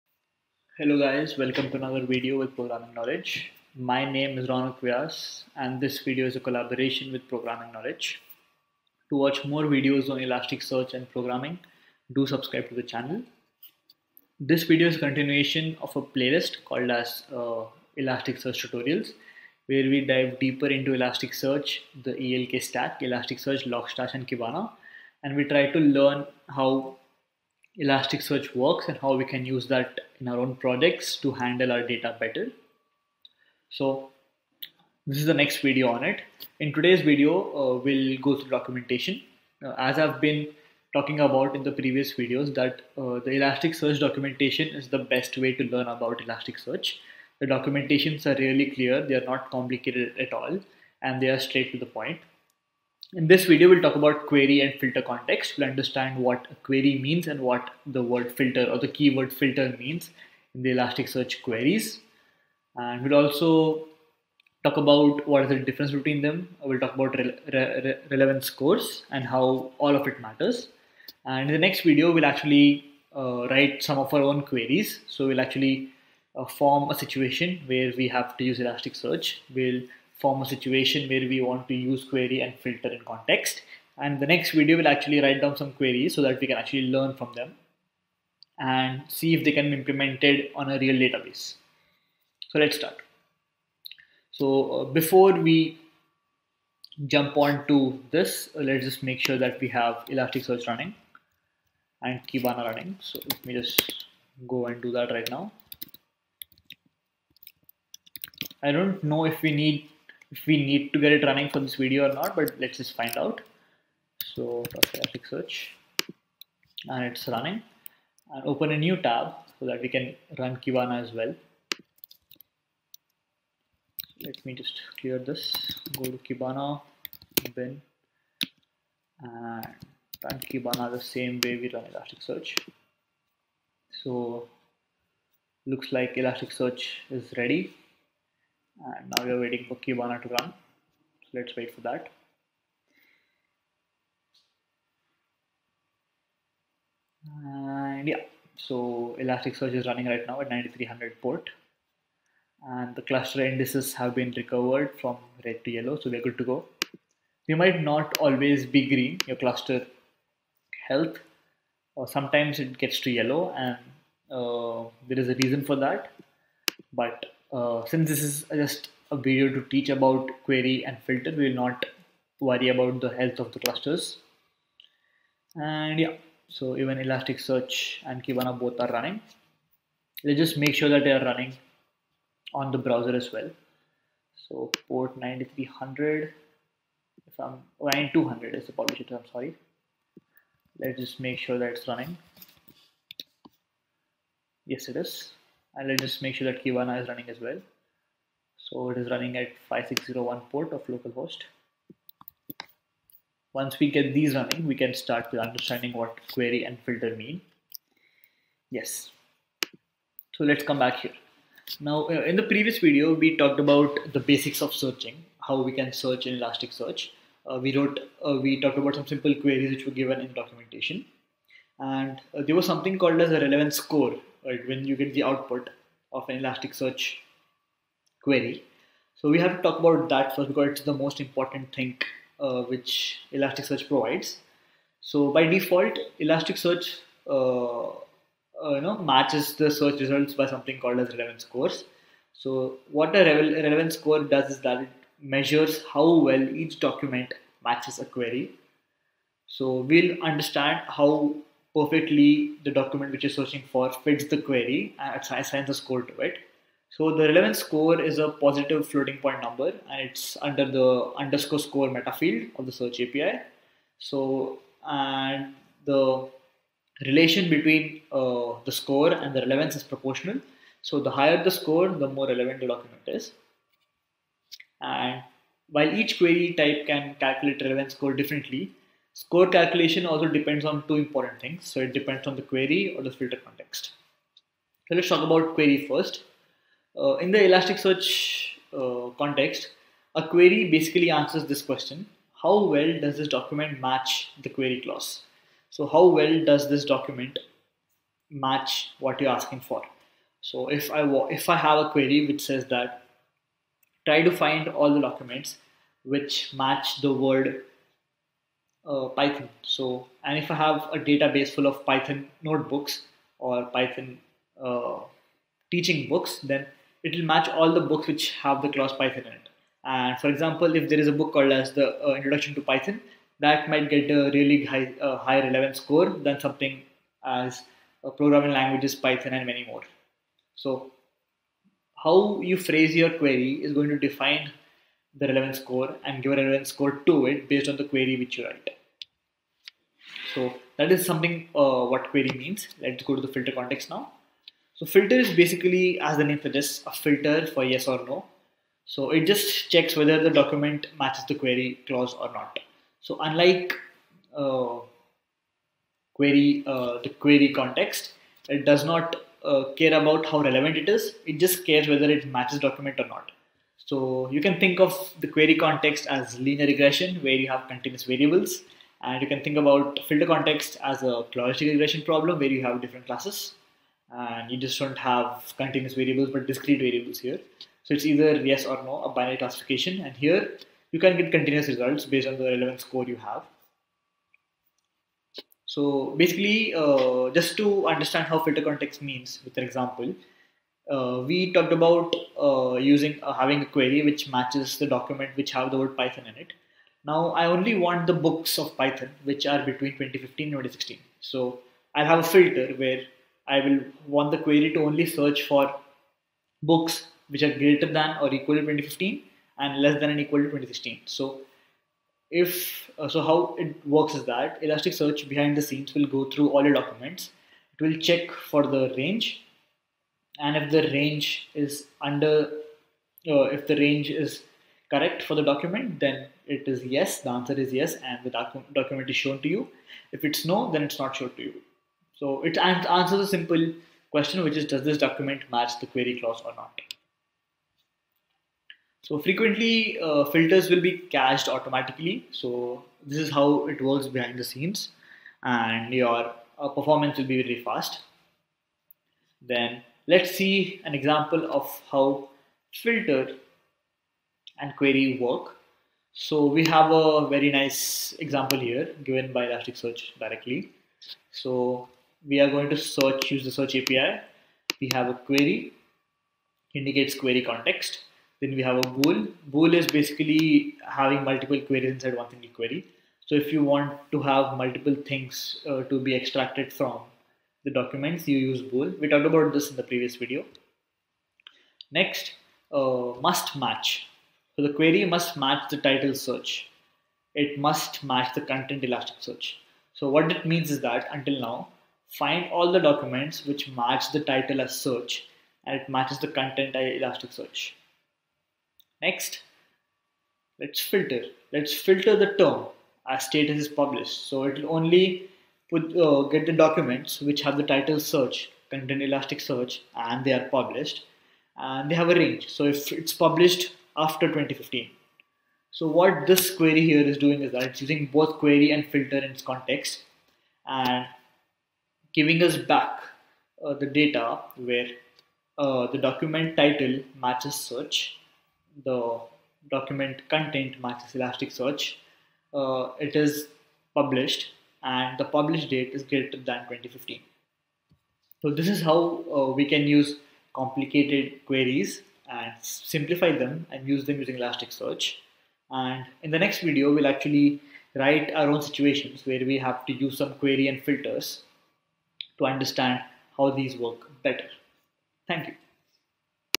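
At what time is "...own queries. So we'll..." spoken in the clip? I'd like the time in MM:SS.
01:14.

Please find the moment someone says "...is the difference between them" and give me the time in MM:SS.
01:05.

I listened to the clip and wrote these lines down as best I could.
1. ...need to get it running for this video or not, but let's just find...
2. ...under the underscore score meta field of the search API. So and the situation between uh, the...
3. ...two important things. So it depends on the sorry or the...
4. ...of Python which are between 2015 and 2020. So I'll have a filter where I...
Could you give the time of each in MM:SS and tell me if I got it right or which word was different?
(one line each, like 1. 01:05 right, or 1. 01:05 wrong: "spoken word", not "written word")
1. 01:50 right
2. 04:20 wrong: "relation", not "situation"
3. 04:40 wrong: "query", not "sorry"
4. 06:38 wrong: "2016", not "2020".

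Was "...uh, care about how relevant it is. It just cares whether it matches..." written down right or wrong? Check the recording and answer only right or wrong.
right.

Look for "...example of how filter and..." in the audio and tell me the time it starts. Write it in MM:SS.
07:30.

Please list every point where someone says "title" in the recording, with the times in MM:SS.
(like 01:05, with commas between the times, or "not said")
08:05, 08:14, 08:27, 08:46.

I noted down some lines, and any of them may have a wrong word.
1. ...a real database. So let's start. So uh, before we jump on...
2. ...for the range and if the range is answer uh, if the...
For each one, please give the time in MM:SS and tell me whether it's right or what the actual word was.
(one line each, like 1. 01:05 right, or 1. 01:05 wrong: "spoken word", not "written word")
1. 01:30 right
2. 06:58 wrong: "under", not "answer".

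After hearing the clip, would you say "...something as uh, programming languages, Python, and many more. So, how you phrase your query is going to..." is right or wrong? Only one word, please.
right.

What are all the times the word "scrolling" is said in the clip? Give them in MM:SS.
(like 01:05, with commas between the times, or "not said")
not said.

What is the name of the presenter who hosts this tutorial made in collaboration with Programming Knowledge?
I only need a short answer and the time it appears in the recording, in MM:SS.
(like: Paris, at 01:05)
Rounak Vyas, at 00:04.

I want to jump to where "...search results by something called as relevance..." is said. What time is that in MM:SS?
03:59.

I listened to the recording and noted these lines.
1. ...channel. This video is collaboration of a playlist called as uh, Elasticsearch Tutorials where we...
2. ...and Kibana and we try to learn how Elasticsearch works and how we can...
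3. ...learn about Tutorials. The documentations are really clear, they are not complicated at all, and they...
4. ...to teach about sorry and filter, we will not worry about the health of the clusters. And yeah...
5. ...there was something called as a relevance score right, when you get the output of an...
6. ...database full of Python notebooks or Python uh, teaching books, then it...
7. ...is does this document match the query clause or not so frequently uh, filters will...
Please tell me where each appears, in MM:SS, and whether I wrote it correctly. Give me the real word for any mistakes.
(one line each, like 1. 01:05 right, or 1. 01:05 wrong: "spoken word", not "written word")
1. 00:12 wrong: "continuation", not "collaboration"
2. 00:24 right
3. 00:45 wrong: "Elasticsearch", not "Tutorials"
4. 02:49 wrong: "query", not "sorry"
5. 03:42 right
6. 05:10 right
7. 07:14 right.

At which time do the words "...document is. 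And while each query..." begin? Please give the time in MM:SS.
04:32.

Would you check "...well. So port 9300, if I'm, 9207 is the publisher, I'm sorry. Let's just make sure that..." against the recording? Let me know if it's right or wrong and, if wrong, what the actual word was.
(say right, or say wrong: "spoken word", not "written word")
wrong: "9200", not "9207".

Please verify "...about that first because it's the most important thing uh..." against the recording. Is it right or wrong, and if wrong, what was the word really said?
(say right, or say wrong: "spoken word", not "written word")
right.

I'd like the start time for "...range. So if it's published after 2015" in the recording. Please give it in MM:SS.
08:32.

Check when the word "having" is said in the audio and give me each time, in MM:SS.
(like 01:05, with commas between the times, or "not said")
06:33, 07:50.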